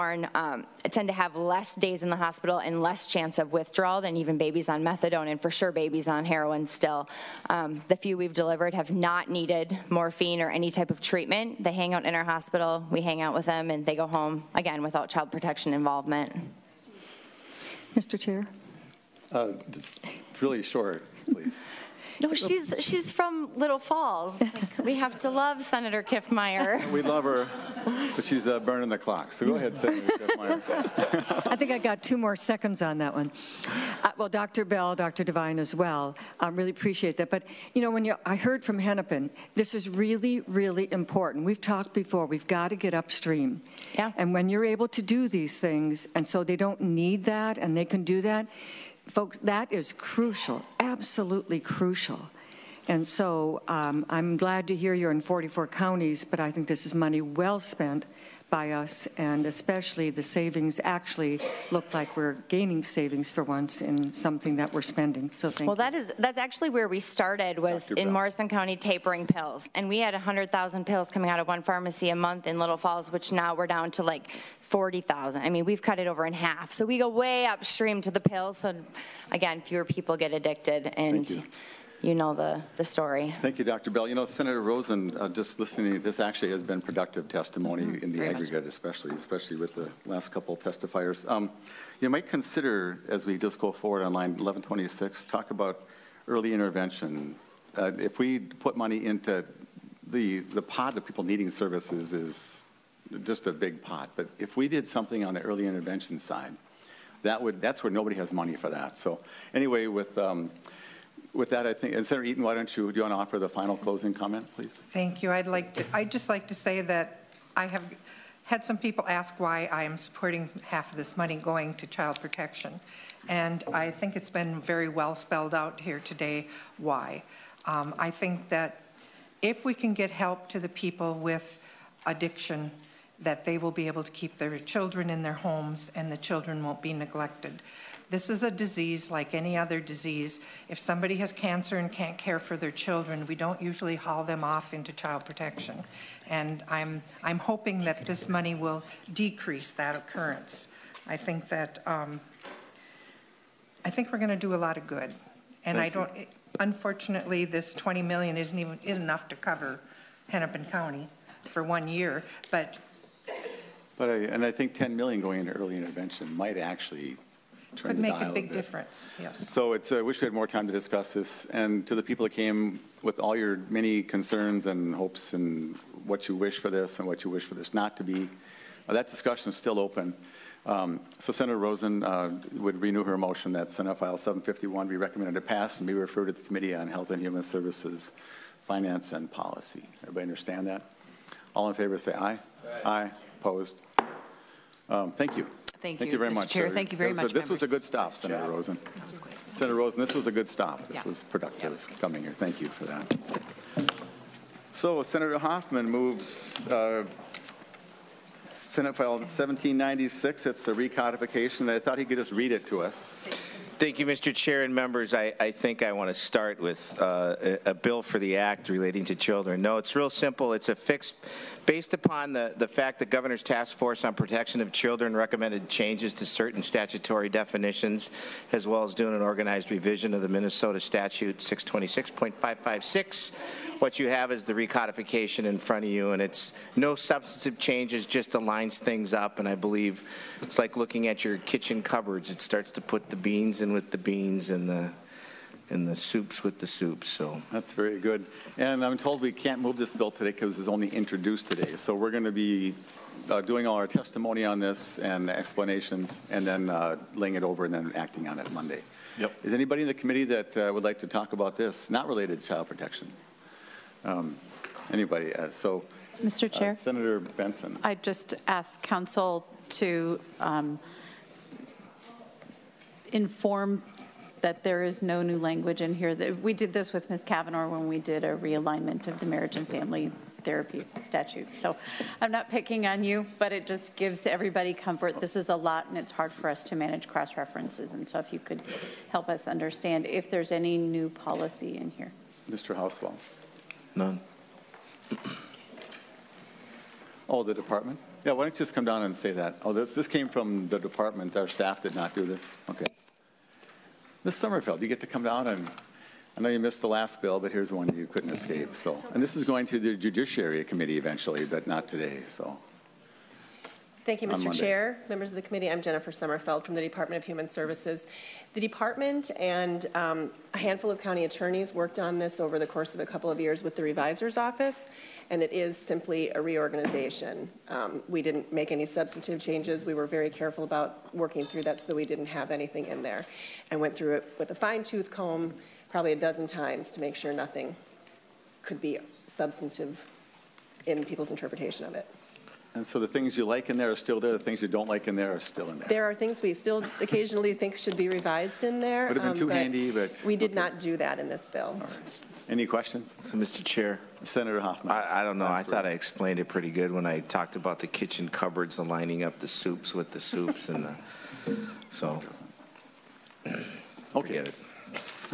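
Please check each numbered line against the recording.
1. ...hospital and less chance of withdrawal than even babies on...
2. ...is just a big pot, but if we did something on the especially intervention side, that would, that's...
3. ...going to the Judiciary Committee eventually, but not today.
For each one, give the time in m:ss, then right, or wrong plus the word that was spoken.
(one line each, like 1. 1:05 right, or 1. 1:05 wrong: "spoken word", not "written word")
1. 0:02 right
2. 1:42 wrong: "early", not "especially"
3. 5:09 right.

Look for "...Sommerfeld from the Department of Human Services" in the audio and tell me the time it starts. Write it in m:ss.
5:16.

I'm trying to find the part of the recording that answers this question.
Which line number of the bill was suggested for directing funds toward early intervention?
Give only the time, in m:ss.
1:34.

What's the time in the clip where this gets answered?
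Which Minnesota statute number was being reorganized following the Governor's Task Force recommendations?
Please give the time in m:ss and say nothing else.
3:51.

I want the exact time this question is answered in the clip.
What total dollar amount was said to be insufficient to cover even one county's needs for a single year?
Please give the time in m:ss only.
2:37.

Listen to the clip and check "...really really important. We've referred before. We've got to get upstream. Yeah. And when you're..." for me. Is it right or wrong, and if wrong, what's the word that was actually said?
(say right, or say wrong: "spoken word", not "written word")
wrong: "talked", not "referred".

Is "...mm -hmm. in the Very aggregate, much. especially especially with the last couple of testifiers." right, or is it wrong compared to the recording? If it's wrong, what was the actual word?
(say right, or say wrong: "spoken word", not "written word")
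right.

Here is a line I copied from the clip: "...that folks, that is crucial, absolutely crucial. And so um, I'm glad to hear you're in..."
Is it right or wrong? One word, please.
right.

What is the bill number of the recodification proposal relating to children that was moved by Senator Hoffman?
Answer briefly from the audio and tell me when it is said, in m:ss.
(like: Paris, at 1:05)
Senate File 1796, at 3:28.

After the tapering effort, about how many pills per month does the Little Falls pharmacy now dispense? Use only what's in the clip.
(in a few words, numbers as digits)
40,000.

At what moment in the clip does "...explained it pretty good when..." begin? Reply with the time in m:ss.
5:55.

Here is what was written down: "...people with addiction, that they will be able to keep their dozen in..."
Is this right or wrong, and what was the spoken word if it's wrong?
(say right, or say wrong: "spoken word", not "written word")
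wrong: "children", not "dozen".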